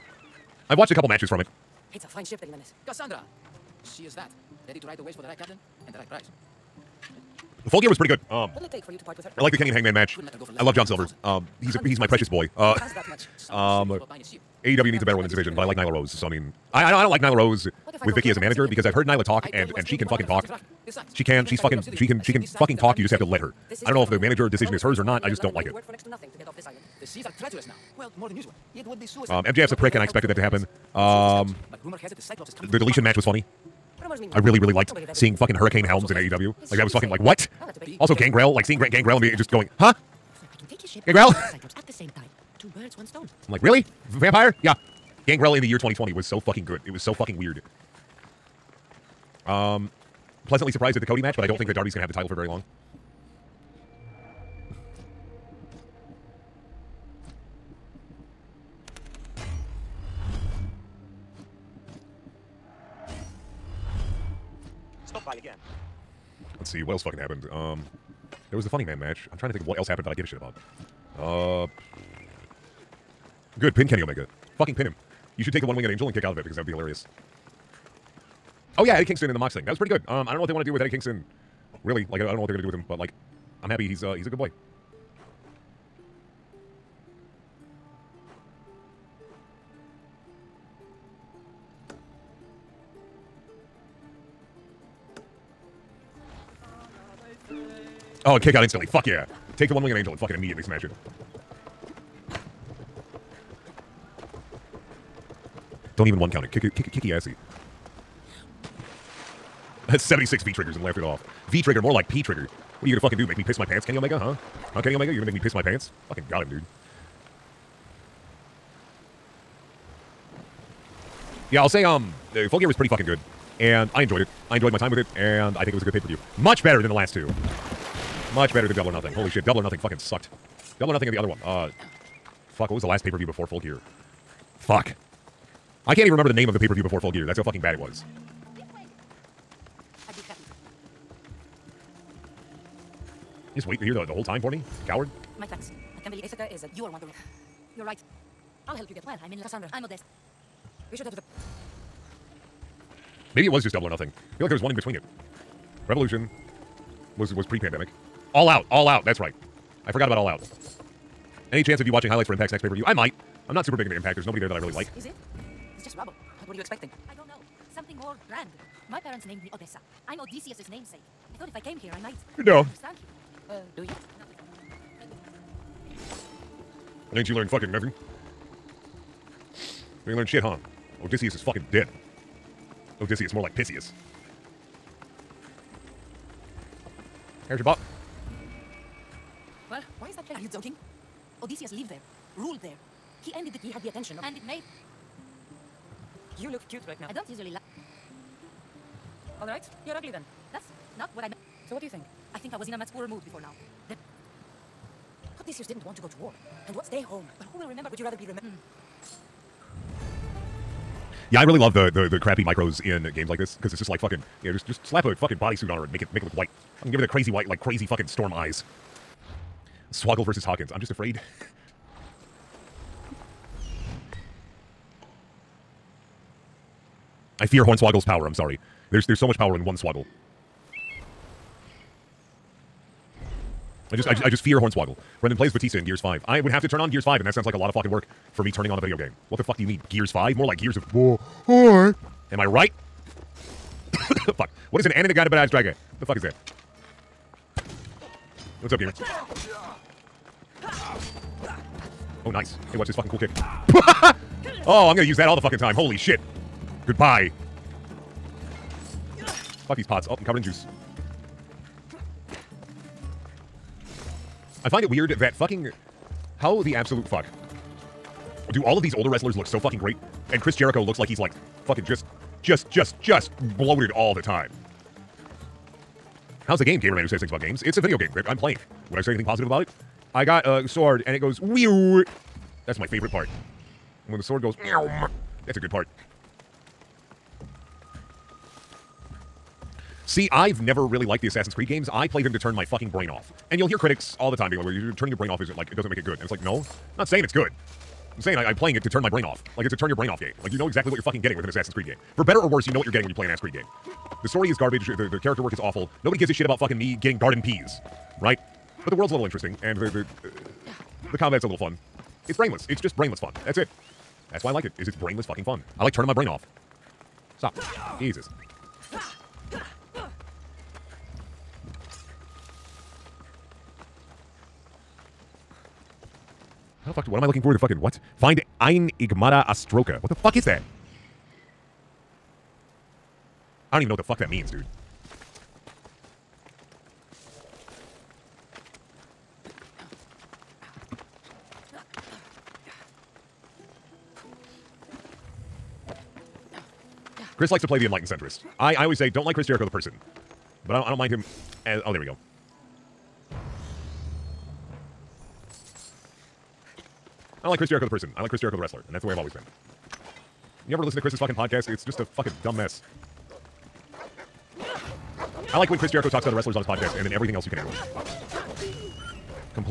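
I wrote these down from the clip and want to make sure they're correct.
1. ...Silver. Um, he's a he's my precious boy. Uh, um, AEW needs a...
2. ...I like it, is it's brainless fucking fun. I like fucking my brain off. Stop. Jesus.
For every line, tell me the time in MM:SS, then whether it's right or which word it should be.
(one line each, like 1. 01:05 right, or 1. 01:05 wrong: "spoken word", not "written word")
1. 00:10 right
2. 05:14 wrong: "turning", not "fucking".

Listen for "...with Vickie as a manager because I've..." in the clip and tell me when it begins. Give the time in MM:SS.
00:18.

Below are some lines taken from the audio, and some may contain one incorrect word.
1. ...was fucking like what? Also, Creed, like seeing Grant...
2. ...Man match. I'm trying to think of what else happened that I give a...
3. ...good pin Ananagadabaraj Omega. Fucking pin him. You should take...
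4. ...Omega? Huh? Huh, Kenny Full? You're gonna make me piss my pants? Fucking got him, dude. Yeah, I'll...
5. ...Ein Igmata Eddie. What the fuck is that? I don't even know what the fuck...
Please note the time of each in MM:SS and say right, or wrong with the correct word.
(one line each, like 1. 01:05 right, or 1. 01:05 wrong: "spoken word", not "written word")
1. 00:36 wrong: "Gangrel", not "Creed"
2. 01:08 right
3. 01:13 wrong: "Kenny", not "Ananagadabaraj"
4. 01:53 wrong: "Omega", not "Full"
5. 05:28 wrong: "Astroka", not "Eddie".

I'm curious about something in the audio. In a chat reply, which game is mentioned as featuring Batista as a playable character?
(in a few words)
Gears 5.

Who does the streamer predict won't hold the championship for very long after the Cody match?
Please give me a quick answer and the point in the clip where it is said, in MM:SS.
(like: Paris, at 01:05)
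Darby, at 00:51.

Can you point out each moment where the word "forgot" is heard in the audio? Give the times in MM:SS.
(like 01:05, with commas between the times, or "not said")
02:39.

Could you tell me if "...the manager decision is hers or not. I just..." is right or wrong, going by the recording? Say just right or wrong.
right.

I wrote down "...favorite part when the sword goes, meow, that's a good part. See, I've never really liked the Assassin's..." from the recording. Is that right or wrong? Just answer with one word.
right.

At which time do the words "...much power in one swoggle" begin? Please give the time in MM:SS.
03:49.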